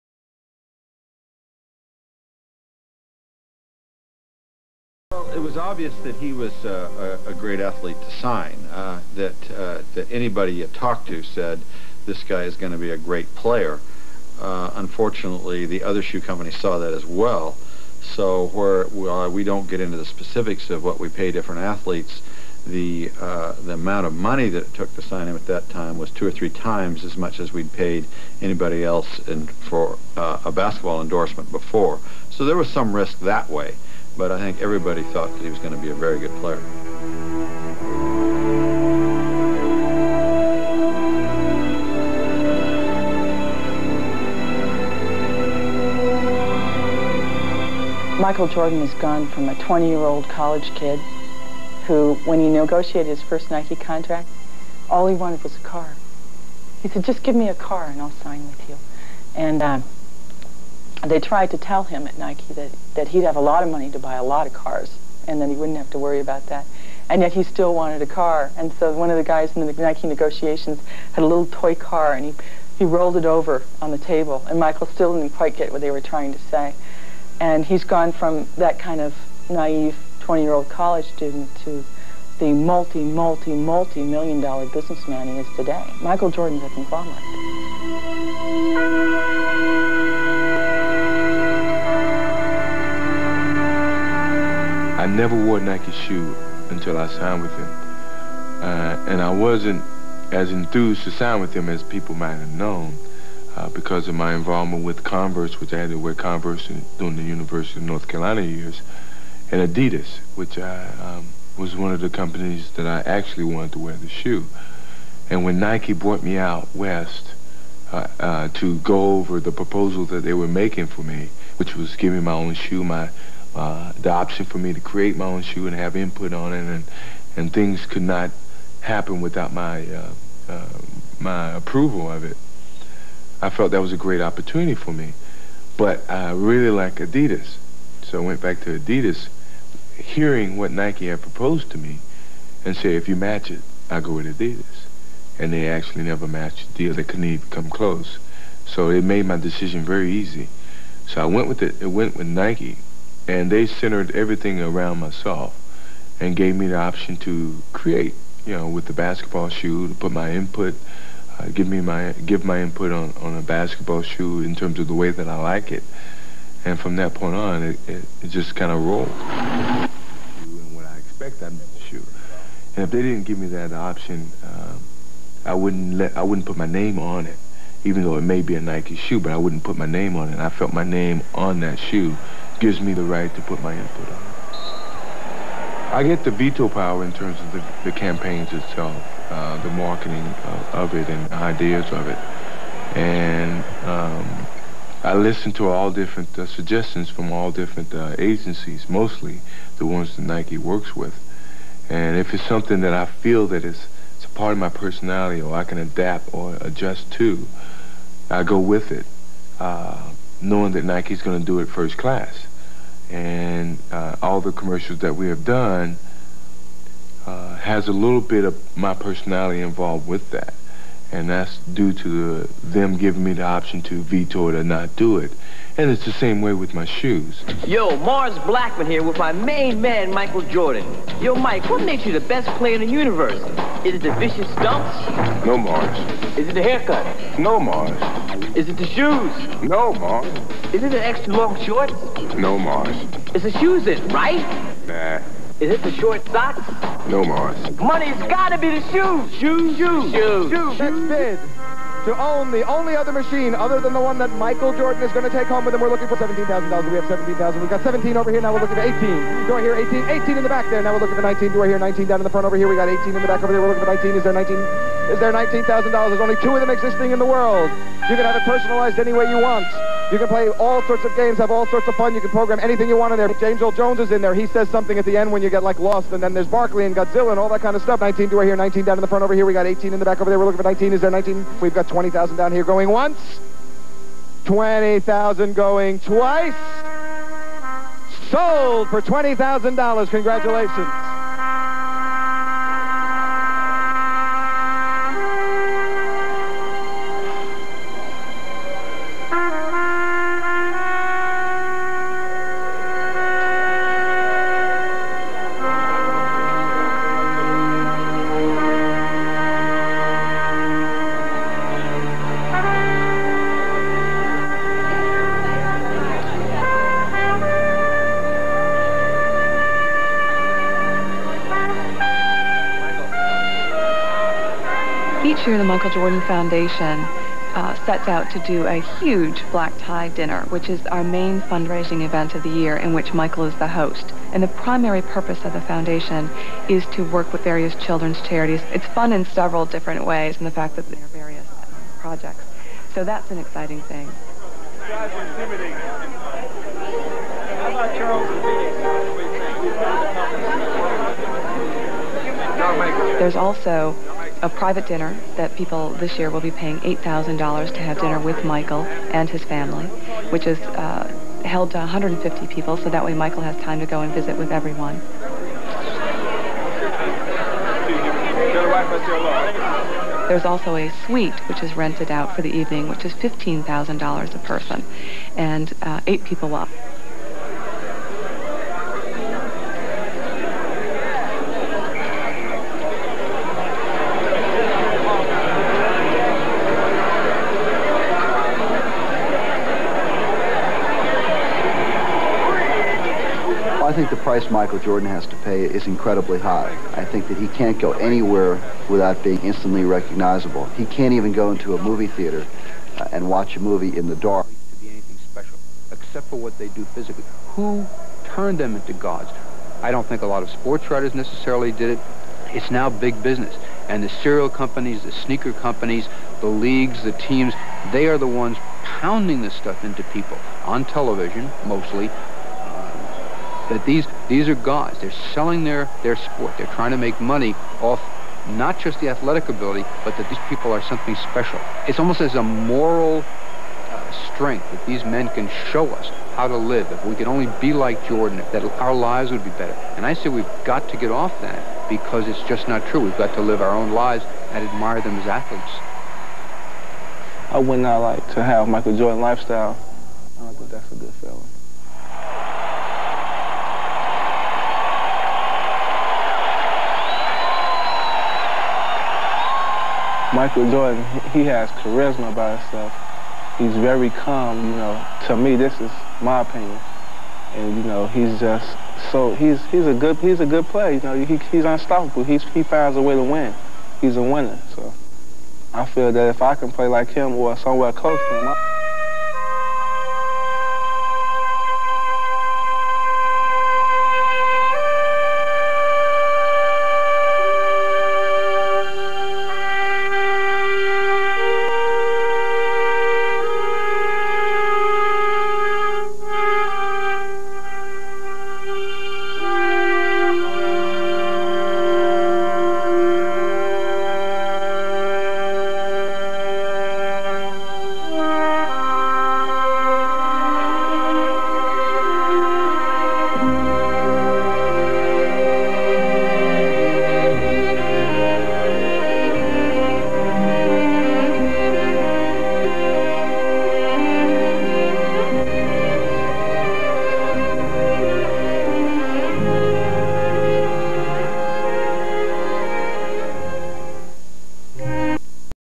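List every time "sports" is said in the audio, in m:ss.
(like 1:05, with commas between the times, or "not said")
6:50, 7:06.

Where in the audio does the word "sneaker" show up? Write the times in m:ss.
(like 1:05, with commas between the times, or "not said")
6:55.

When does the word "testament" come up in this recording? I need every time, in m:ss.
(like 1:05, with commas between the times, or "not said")
not said.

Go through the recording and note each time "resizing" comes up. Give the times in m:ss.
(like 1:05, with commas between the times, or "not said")
not said.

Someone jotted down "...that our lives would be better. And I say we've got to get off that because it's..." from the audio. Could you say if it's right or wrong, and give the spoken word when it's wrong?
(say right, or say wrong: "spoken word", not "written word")
right.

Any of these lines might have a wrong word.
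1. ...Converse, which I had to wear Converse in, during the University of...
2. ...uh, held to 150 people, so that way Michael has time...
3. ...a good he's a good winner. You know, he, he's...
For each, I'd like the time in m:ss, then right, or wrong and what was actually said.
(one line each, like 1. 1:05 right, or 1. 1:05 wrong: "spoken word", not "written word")
1. 1:45 right
2. 6:00 right
3. 7:49 wrong: "player", not "winner".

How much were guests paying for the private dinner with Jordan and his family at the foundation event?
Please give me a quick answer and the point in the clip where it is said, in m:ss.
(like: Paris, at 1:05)
$8,000, at 5:56.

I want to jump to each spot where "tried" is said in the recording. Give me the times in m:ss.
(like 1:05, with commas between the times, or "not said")
1:01.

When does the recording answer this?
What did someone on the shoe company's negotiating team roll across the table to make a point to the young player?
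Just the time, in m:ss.
1:11.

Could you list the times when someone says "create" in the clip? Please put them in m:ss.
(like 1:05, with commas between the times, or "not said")
2:04, 2:37.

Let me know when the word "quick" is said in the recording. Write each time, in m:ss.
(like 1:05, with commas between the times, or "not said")
not said.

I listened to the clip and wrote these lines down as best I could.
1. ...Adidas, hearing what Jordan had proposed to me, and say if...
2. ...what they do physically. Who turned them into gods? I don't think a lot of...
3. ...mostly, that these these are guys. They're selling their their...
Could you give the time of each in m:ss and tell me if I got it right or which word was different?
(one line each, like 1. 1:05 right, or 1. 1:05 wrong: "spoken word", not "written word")
1. 2:18 wrong: "Nike", not "Jordan"
2. 6:46 right
3. 7:01 right.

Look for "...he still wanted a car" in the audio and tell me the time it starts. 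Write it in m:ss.
1:07.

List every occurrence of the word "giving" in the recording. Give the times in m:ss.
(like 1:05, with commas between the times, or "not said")
2:01, 3:42.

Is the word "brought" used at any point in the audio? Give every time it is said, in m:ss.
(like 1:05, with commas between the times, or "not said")
1:55.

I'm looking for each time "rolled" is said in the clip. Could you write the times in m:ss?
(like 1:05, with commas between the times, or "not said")
1:12, 2:48.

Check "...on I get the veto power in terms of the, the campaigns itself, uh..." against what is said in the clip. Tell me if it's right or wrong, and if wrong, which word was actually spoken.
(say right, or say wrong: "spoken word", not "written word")
right.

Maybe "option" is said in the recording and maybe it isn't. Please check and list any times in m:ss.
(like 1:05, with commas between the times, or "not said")
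2:04, 2:36, 2:53, 3:43.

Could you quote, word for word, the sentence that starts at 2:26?
They couldn't even come close, so it made my decision very easy.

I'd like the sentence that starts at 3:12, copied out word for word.
And um, I listen to all different uh, suggestions from all different uh, agencies, mostly the ones that Nike works with.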